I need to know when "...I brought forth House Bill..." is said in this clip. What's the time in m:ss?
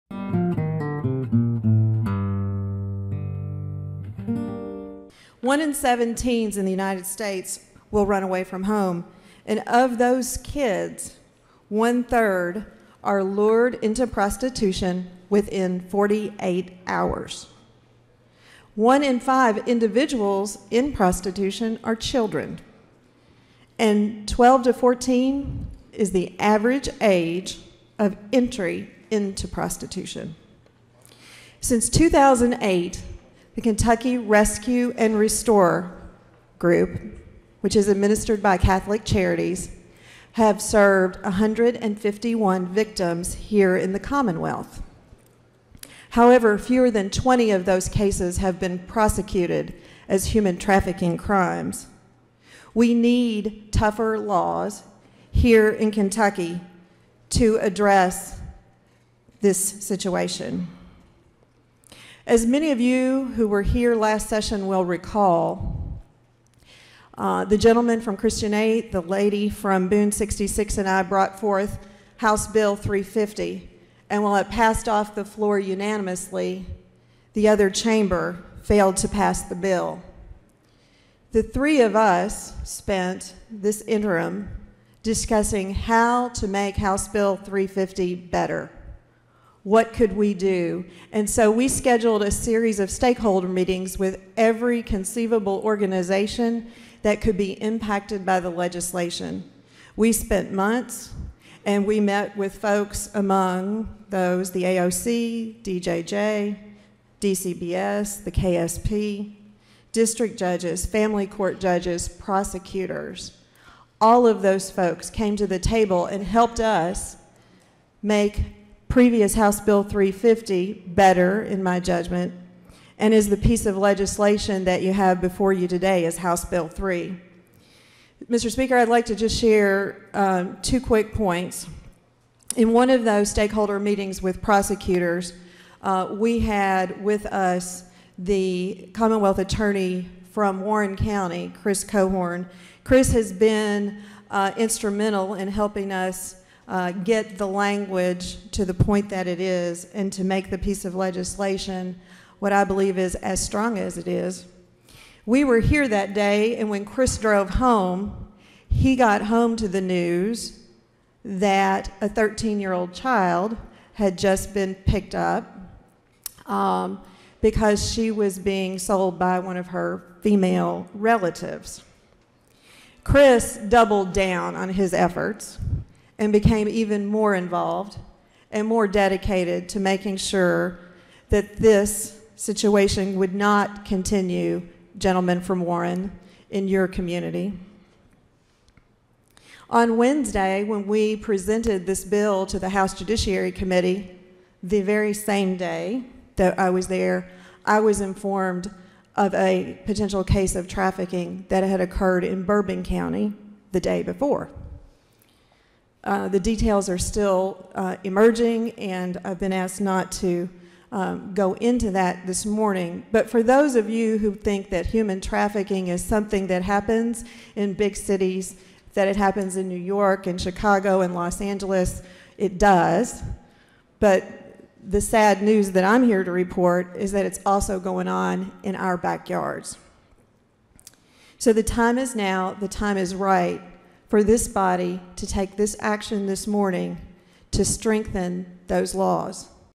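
1:10.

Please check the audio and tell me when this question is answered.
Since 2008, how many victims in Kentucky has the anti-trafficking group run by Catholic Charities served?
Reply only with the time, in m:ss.
0:41.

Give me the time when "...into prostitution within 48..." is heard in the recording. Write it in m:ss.
0:13.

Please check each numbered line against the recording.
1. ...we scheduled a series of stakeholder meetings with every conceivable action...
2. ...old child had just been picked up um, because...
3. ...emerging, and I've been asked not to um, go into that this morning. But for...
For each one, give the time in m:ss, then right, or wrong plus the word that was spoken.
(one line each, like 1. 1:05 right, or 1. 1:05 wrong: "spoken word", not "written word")
1. 1:31 wrong: "organization", not "action"
2. 2:42 right
3. 3:28 right.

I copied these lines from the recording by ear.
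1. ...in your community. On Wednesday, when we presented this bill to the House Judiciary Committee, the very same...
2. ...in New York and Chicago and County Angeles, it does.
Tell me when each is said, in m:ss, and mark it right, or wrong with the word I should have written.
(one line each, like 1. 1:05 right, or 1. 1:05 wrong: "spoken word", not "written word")
1. 3:06 right
2. 3:39 wrong: "Los", not "County".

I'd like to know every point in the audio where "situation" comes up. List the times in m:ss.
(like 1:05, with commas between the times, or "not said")
0:59, 3:02.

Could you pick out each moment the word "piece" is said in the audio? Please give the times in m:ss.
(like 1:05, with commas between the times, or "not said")
2:03, 2:30.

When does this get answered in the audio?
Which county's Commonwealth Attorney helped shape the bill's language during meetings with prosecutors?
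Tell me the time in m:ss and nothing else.
2:20.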